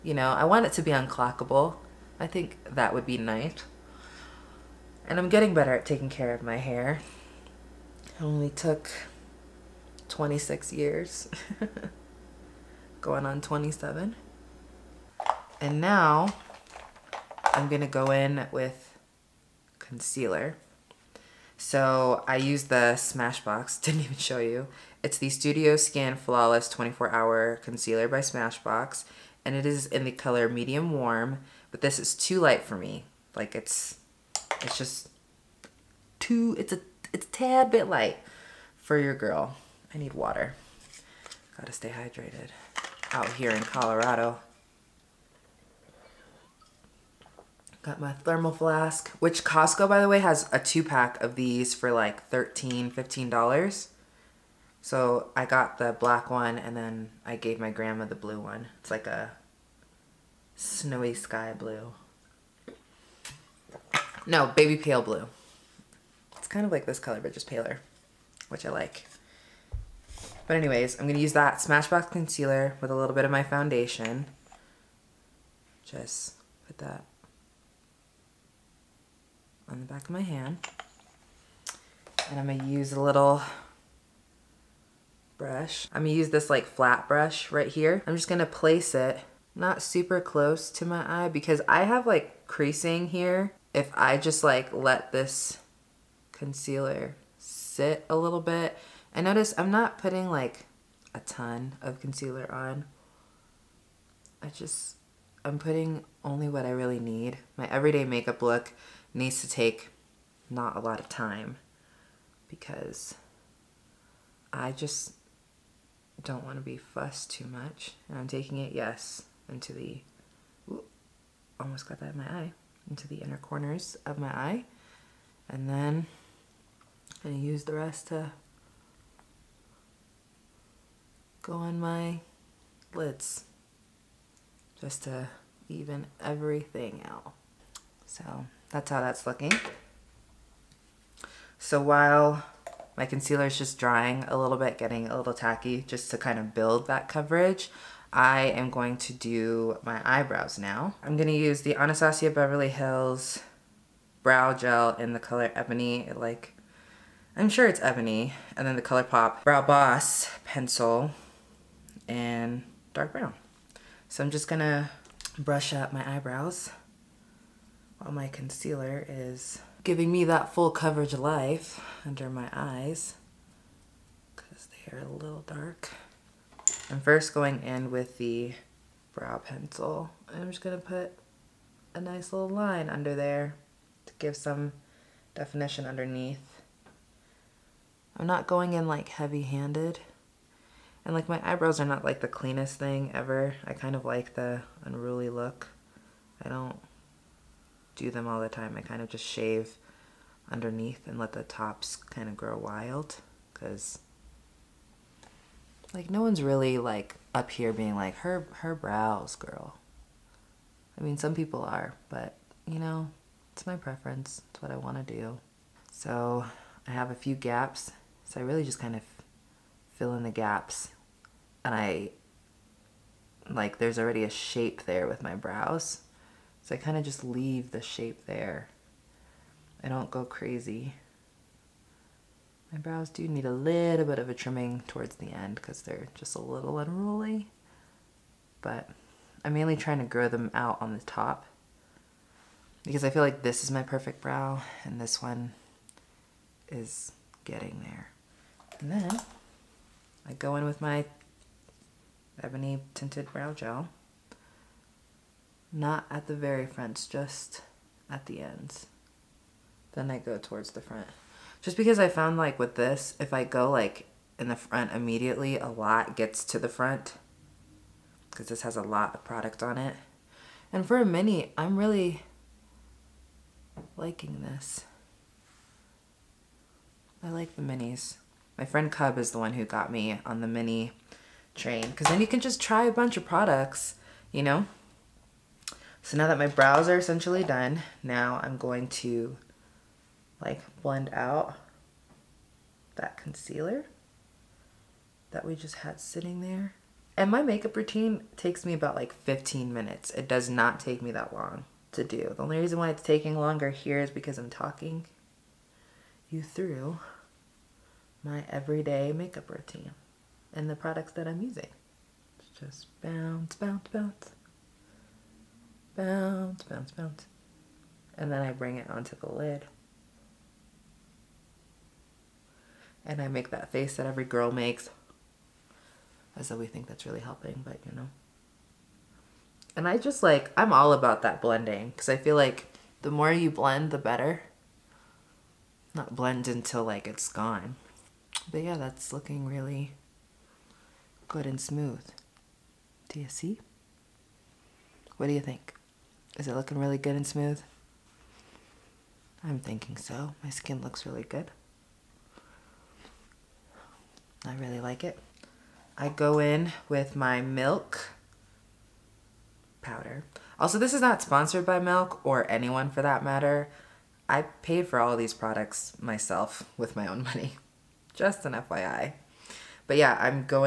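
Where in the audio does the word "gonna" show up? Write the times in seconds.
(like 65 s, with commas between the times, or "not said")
17 s, 127 s, 151 s, 164 s.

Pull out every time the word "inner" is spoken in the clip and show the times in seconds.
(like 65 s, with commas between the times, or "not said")
123 s.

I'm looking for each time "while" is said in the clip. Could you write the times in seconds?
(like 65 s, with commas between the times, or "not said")
141 s, 167 s.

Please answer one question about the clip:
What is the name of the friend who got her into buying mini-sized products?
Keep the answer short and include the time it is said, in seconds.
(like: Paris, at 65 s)
Cub, at 278 s.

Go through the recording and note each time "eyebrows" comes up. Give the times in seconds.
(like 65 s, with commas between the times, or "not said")
150 s, 166 s, 191 s.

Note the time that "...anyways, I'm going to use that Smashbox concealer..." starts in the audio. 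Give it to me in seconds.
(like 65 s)
70 s.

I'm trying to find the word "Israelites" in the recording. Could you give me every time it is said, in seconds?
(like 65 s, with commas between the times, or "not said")
not said.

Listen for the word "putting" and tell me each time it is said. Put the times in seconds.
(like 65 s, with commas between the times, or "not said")
99 s, 105 s.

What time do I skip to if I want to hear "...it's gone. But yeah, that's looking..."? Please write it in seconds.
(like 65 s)
337 s.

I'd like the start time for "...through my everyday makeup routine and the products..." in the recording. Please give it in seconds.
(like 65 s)
306 s.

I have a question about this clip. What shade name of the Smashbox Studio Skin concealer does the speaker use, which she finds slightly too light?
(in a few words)
Medium Warm.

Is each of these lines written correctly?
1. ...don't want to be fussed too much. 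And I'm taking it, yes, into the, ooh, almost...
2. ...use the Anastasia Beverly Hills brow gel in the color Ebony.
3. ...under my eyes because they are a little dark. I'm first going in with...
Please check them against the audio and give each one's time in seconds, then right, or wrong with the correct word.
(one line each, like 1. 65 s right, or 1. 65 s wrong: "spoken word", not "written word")
1. 116 s right
2. 151 s right
3. 172 s right.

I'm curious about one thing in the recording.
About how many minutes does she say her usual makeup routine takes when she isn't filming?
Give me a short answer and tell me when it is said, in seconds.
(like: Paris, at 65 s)
15, at 299 s.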